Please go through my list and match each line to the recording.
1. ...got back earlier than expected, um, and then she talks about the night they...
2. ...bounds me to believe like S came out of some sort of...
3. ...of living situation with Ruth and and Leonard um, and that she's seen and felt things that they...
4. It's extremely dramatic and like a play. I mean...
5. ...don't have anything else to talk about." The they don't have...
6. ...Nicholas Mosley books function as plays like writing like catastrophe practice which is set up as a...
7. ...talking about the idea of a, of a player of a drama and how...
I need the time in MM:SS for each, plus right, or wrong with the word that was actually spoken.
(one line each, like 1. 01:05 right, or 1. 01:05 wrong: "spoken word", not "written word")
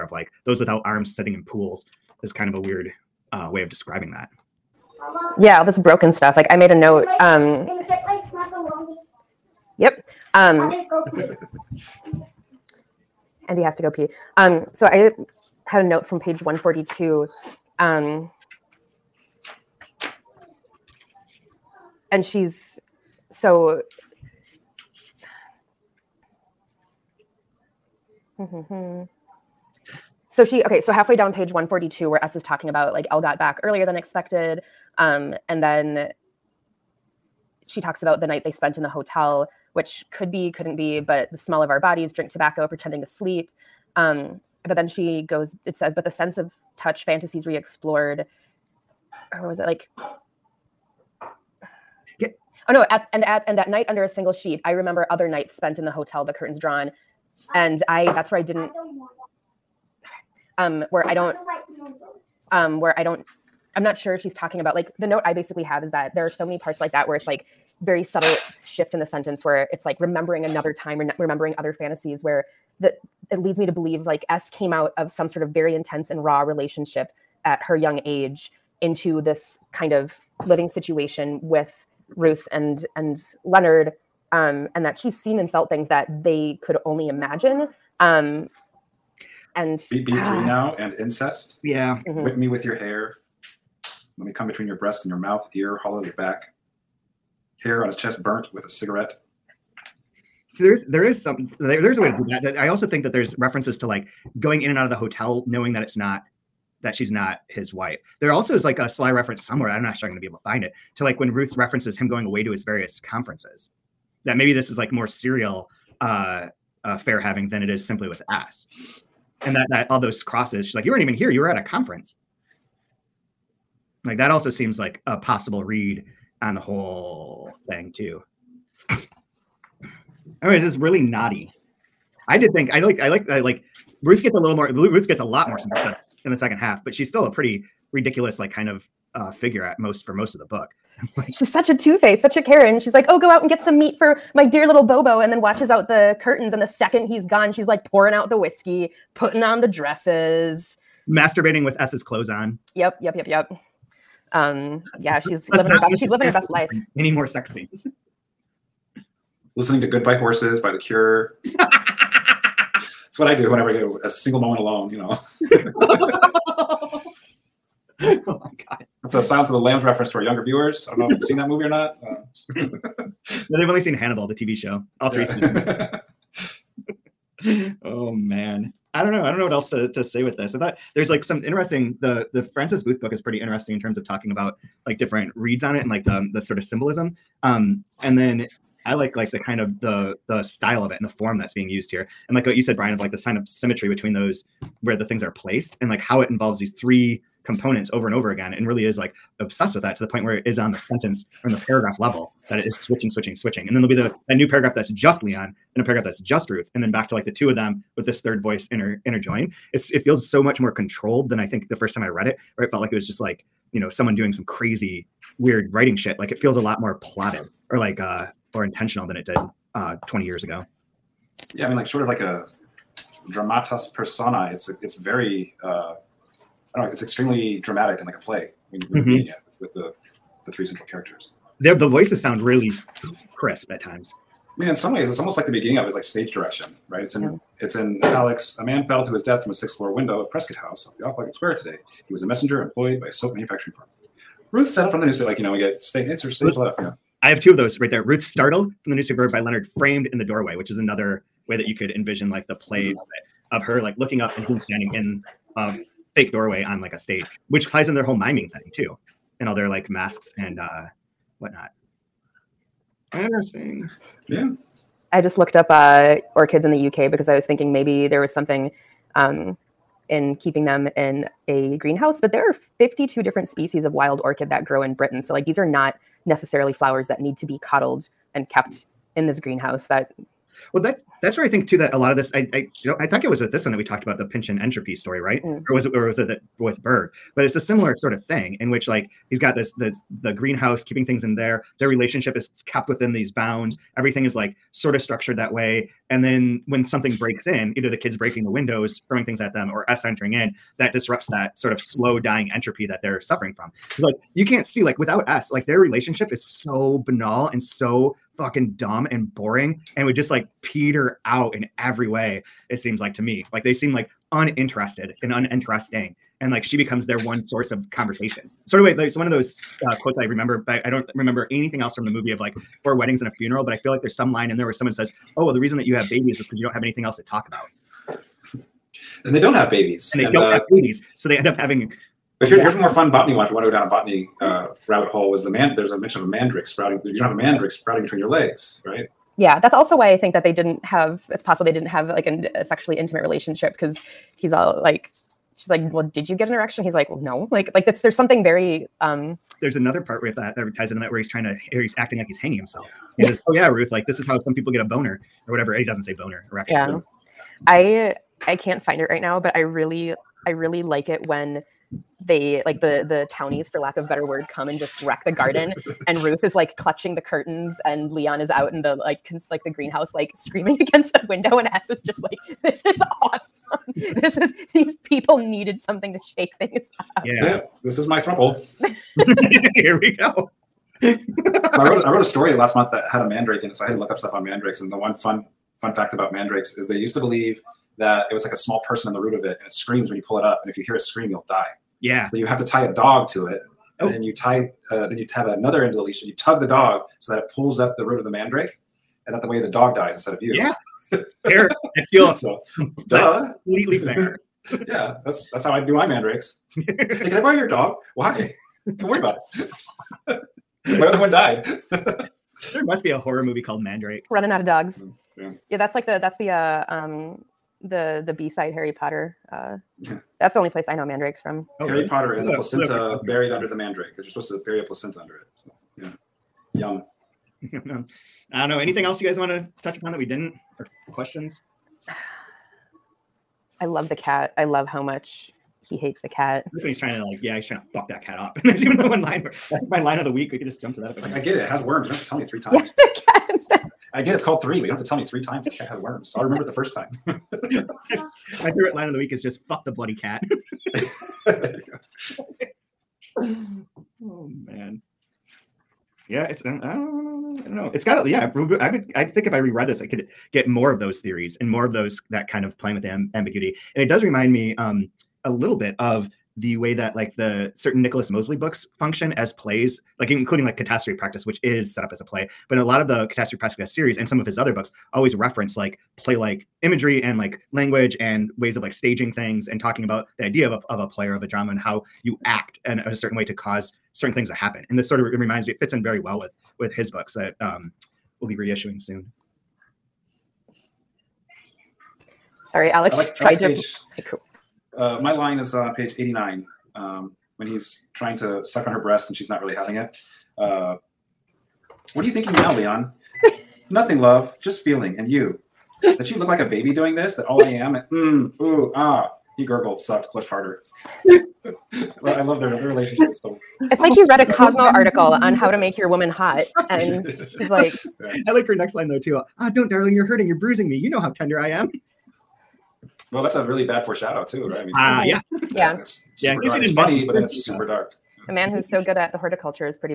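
1. 00:33 right
2. 01:13 wrong: "leads", not "bounds"
3. 01:19 right
4. 03:46 right
5. 05:26 wrong: "And", not "The"
6. 07:48 wrong: "including", not "writing"
7. 07:59 right.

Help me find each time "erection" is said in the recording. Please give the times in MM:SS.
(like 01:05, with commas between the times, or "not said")
05:46, 05:56.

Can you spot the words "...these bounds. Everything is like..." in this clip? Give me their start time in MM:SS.
04:53.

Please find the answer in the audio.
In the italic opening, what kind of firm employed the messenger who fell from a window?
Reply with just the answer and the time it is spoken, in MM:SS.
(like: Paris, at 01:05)
A soap manufacturing firm, at 04:03.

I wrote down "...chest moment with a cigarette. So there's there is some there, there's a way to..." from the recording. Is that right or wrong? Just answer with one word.
wrong.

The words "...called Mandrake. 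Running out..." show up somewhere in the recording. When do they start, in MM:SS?
06:53.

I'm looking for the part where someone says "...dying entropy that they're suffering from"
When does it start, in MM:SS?
05:02.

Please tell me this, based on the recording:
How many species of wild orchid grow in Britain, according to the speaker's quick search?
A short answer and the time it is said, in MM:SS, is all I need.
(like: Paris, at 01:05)
52, at 04:32.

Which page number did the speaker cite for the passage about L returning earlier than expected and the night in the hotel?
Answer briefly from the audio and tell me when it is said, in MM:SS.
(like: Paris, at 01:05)
142, at 00:16.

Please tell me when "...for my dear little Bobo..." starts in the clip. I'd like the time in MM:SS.
02:23.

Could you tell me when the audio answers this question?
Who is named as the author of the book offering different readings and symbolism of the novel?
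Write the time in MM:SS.
03:02.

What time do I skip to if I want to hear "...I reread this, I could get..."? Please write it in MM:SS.
07:39.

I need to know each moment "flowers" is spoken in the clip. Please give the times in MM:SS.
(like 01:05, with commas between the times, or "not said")
04:36.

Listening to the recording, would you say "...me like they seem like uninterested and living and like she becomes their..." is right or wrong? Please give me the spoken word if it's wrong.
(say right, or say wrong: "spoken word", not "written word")
wrong: "uninteresting", not "living".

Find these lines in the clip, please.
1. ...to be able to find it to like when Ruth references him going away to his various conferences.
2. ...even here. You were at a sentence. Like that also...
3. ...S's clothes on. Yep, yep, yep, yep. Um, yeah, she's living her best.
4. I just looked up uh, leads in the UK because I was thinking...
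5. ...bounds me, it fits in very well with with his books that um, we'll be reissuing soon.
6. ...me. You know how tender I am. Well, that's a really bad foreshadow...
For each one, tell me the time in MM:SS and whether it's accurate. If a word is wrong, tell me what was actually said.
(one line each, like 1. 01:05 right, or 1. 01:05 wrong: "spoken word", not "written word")
1. 01:50 right
2. 02:01 wrong: "conference", not "sentence"
3. 02:31 right
4. 04:25 wrong: "orchids", not "leads"
5. 08:05 wrong: "reminds", not "bounds"
6. 08:40 right.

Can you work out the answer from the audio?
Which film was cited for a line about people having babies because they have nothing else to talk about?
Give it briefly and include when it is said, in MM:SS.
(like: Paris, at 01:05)
Four Weddings and a Funeral, at 05:22.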